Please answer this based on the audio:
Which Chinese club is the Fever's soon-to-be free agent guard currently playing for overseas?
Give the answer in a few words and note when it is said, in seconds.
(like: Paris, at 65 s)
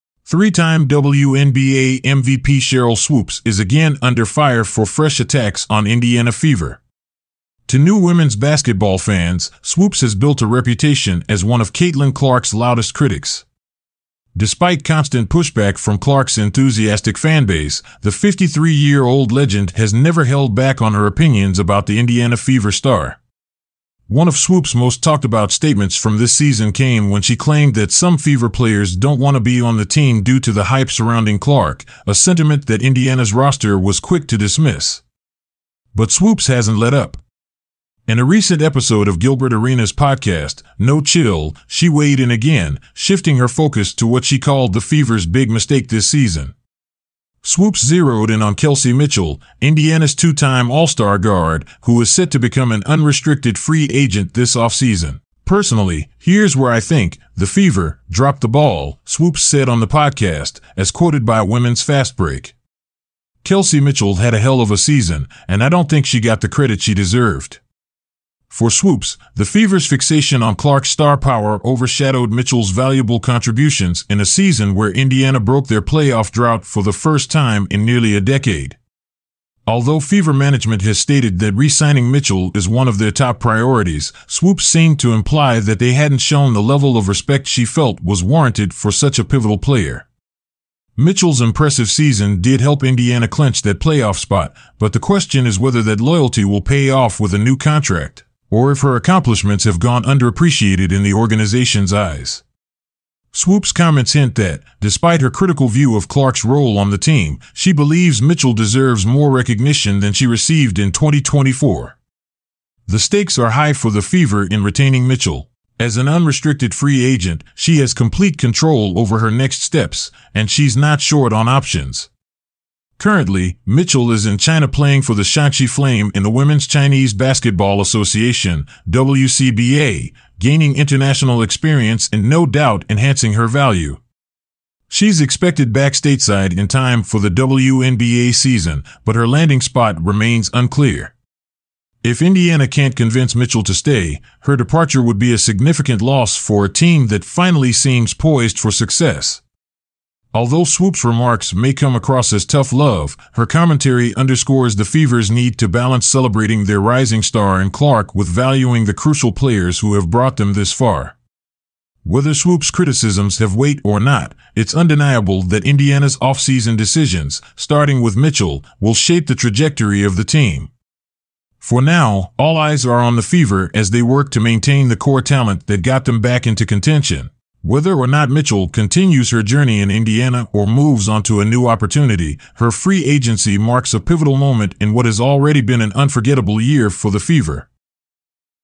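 Shaanxi Flame, at 125 s.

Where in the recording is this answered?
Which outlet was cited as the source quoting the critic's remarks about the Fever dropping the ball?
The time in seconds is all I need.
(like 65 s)
61 s.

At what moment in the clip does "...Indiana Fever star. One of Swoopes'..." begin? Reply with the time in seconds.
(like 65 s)
21 s.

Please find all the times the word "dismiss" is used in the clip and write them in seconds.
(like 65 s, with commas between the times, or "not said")
34 s.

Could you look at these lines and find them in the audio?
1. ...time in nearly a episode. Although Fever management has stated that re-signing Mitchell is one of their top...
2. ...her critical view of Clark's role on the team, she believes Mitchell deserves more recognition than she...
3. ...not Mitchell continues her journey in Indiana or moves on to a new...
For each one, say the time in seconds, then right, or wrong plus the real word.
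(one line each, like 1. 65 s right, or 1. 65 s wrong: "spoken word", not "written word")
1. 77 s wrong: "decade", not "episode"
2. 105 s right
3. 178 s right.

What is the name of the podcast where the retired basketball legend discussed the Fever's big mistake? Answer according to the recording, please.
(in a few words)
No Chill.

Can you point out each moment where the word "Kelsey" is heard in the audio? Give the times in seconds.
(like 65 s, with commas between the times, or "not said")
48 s, 63 s.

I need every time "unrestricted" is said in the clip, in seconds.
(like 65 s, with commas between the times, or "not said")
52 s, 116 s.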